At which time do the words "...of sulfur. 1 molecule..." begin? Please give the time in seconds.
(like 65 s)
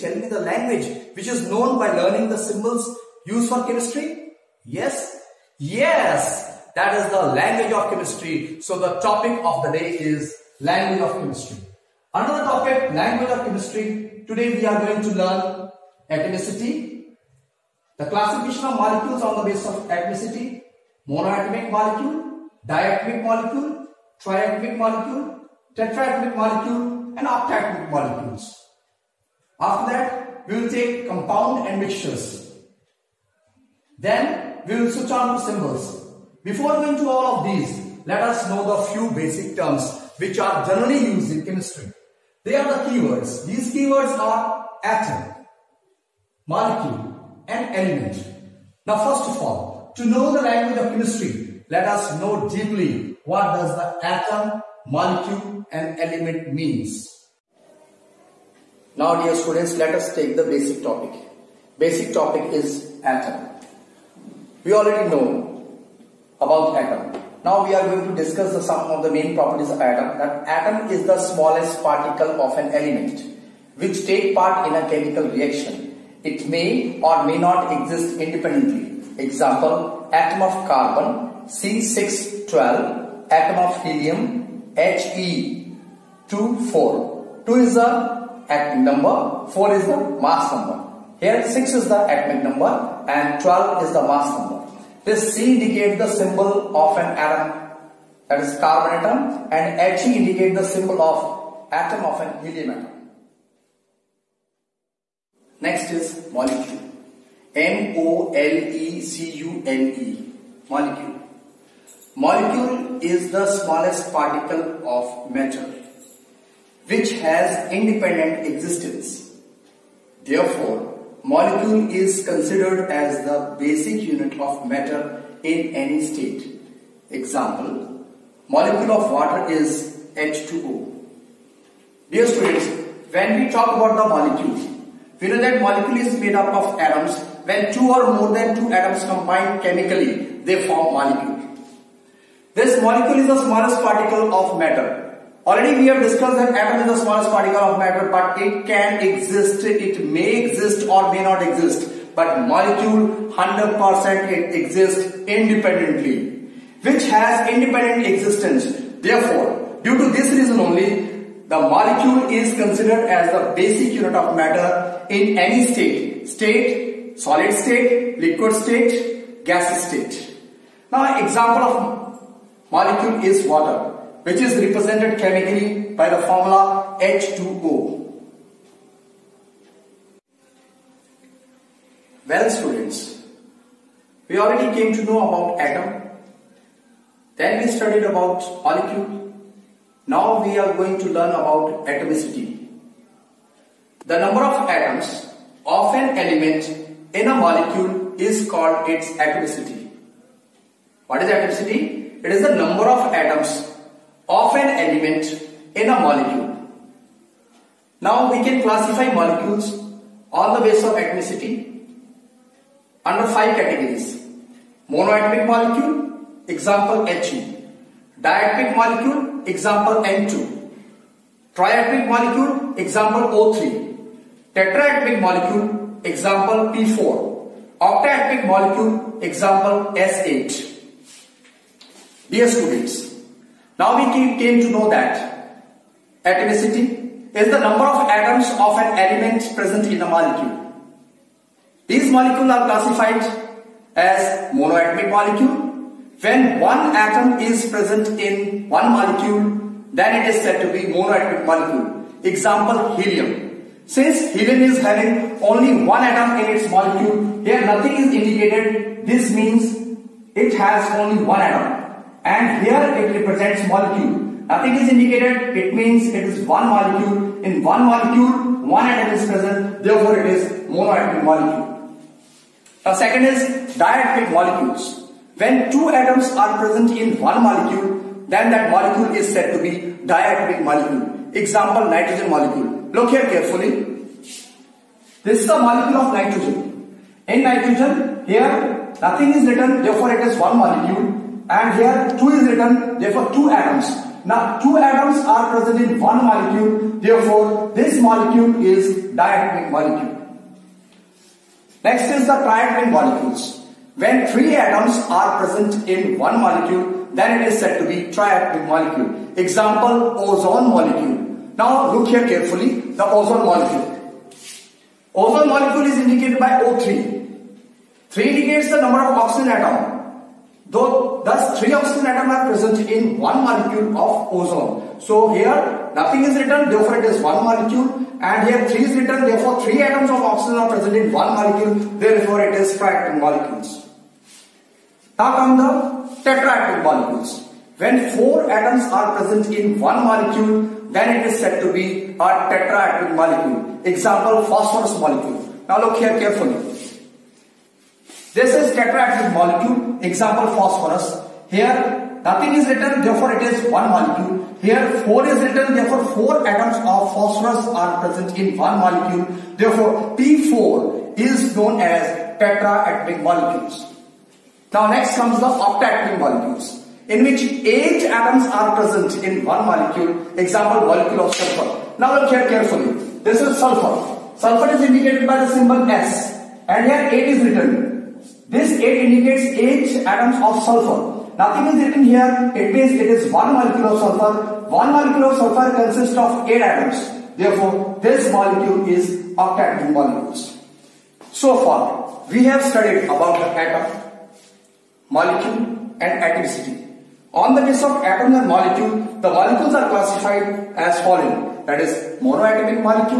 383 s.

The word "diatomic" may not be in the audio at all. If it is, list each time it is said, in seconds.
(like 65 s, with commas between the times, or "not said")
22 s, 218 s, 273 s, 280 s, 299 s.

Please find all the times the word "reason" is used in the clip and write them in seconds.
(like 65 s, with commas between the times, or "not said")
160 s.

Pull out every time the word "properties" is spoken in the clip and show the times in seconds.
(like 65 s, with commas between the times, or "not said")
69 s.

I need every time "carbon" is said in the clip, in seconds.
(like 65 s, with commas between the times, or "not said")
80 s, 98 s.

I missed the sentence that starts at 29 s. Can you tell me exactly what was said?
After that, we will take compound and mixtures.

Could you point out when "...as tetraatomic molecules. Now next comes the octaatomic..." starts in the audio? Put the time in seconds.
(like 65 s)
361 s.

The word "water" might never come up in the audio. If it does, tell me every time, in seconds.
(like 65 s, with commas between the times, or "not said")
129 s, 173 s.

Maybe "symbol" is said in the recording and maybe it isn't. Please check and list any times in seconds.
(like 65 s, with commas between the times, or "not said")
2 s, 35 s, 96 s, 100 s, 375 s.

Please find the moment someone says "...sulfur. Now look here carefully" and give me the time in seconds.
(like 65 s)
371 s.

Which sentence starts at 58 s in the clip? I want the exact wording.
Now dear students, let us take the basic topic.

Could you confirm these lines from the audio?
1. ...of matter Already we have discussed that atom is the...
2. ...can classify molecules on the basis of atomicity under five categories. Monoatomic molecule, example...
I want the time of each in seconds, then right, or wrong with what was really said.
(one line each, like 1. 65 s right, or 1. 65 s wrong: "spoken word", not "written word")
1. 144 s right
2. 208 s right.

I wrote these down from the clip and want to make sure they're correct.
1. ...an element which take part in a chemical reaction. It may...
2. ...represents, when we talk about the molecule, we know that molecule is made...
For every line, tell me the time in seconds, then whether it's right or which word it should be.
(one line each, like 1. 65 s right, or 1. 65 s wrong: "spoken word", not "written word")
1. 72 s right
2. 132 s wrong: "students", not "represents".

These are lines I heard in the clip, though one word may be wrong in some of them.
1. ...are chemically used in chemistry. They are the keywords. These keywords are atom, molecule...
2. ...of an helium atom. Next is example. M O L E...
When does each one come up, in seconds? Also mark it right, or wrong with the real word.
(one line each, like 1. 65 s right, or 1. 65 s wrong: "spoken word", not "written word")
1. 40 s wrong: "generally", not "chemically"
2. 102 s wrong: "molecule", not "example".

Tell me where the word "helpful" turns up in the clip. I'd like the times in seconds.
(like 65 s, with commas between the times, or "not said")
not said.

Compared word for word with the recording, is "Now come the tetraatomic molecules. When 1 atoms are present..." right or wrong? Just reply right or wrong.
wrong.